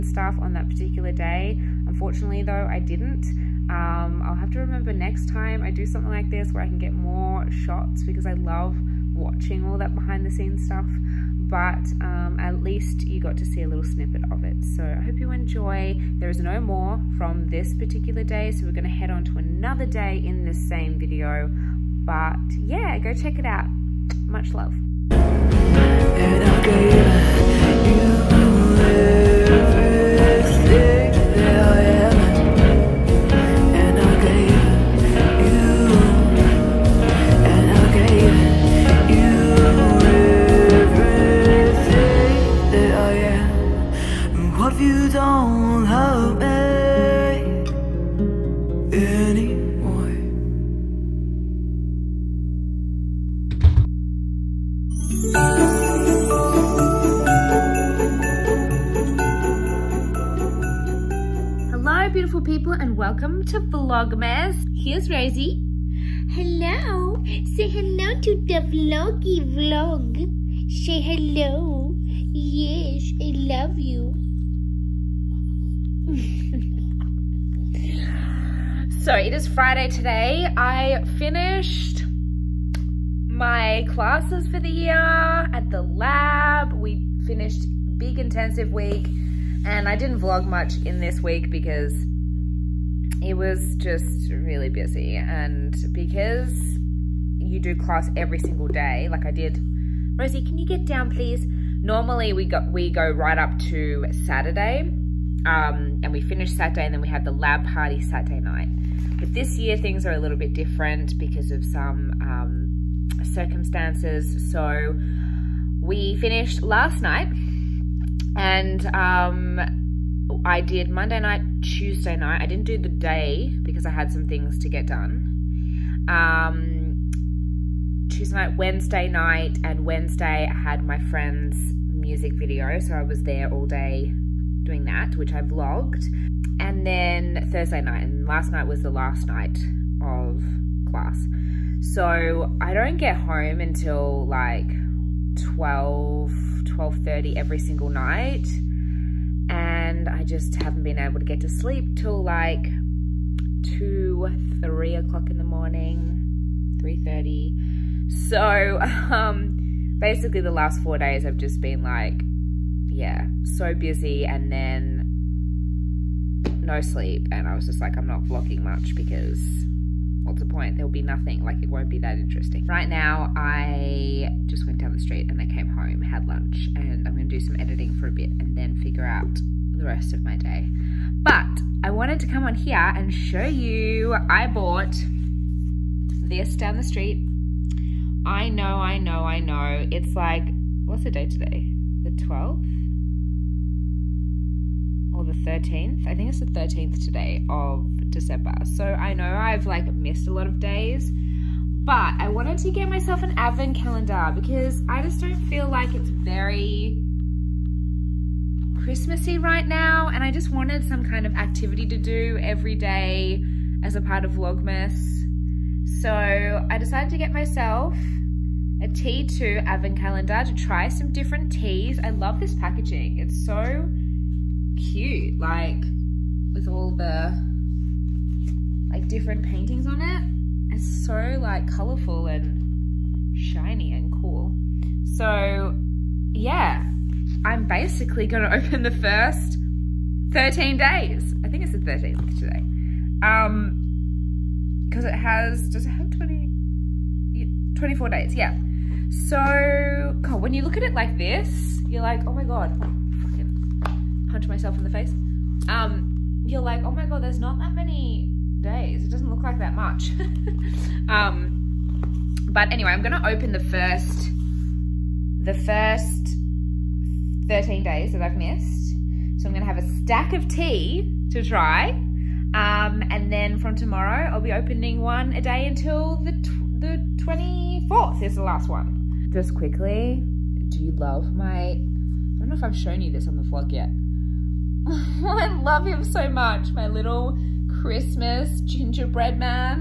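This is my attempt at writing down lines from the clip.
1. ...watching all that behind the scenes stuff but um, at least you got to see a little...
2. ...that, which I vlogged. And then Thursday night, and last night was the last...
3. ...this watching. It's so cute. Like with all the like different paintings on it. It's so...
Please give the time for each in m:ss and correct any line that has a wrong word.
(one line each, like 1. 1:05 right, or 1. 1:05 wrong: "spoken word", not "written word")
1. 0:09 right
2. 2:14 right
3. 3:42 wrong: "packaging", not "watching".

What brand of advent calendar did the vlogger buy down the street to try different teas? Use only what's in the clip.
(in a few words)
T2.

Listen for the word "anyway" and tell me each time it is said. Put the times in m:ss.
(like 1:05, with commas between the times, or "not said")
4:22.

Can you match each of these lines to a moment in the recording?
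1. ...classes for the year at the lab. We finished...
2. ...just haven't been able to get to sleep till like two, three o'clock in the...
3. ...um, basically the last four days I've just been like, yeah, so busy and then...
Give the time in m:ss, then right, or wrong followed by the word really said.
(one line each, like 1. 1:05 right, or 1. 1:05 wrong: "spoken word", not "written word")
1. 1:23 right
2. 2:30 right
3. 2:39 right.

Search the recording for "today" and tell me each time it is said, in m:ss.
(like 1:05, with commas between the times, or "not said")
1:19, 3:11, 3:16, 4:02.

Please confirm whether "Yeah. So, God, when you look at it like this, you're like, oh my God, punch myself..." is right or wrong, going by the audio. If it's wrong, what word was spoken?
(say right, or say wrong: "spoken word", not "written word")
right.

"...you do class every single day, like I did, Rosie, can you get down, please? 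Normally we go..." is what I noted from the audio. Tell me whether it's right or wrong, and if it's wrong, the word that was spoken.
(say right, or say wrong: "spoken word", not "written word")
right.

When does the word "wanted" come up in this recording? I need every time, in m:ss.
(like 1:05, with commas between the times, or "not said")
3:01, 3:22, 3:30.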